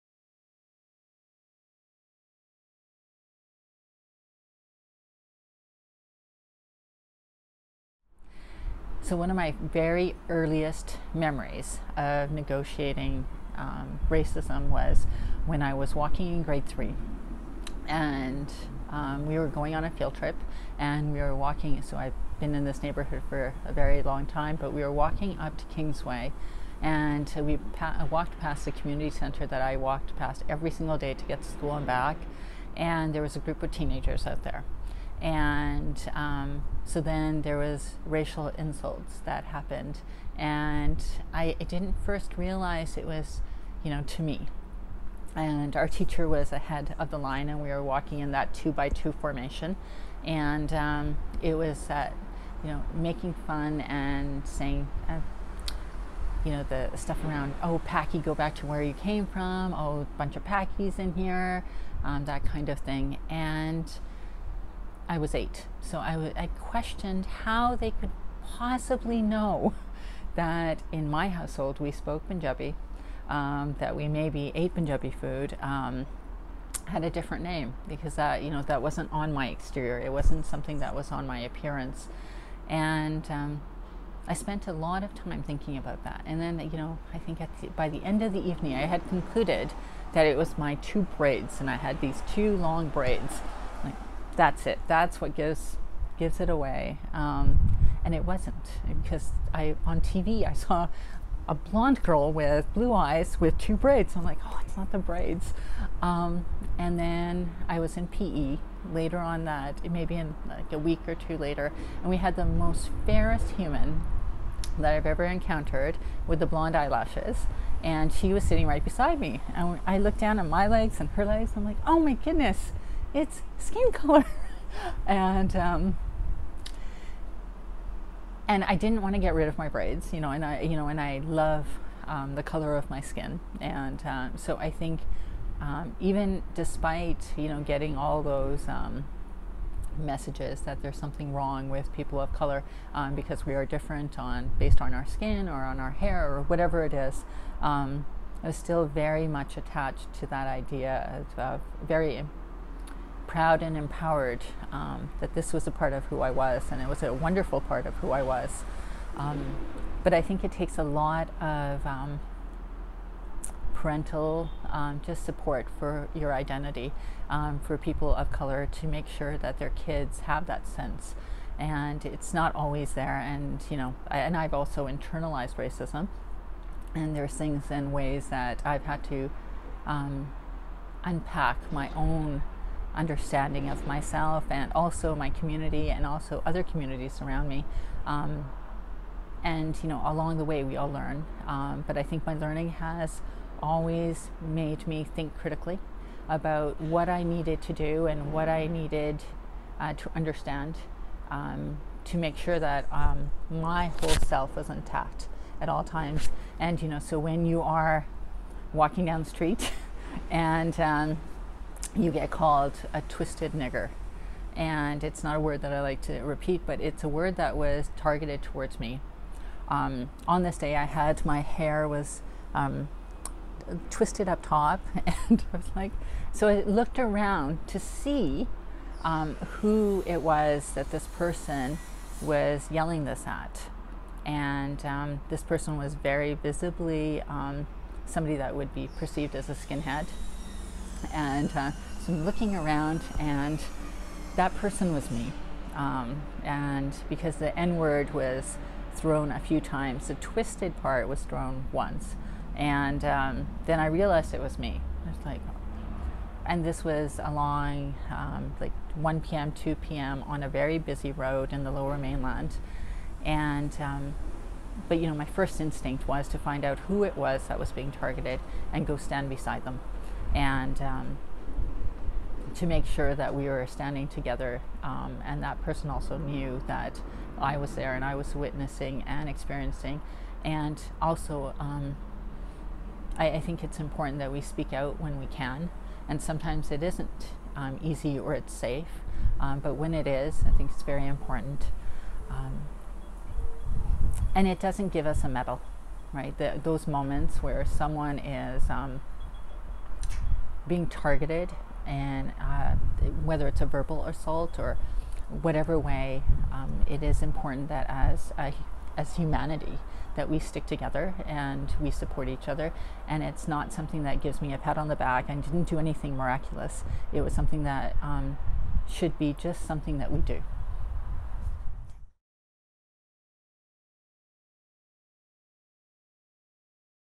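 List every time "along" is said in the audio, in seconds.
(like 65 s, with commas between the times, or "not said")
190 s, 257 s.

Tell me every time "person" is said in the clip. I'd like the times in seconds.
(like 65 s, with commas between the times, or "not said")
231 s, 235 s, 244 s, 275 s.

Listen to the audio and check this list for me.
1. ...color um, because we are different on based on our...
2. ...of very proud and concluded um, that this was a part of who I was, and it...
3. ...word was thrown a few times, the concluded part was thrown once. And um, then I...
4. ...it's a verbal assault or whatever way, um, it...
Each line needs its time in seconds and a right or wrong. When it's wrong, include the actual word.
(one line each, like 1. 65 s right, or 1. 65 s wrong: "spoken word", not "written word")
1. 142 s right
2. 151 s wrong: "empowered", not "concluded"
3. 247 s wrong: "twisted", not "concluded"
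4. 303 s right.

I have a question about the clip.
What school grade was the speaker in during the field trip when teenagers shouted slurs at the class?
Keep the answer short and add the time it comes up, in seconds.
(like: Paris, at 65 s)
Grade 3, at 16 s.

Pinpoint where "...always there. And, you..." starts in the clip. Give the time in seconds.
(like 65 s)
172 s.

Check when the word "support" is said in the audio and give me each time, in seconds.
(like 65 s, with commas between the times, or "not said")
165 s, 311 s.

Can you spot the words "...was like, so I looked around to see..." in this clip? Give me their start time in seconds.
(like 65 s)
225 s.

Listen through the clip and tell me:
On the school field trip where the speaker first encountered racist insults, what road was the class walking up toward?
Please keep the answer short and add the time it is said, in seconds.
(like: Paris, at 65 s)
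Kingsway, at 25 s.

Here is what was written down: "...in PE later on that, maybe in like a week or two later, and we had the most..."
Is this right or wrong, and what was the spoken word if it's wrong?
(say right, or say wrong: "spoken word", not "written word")
right.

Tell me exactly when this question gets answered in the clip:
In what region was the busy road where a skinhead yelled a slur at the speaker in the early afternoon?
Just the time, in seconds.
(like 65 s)
261 s.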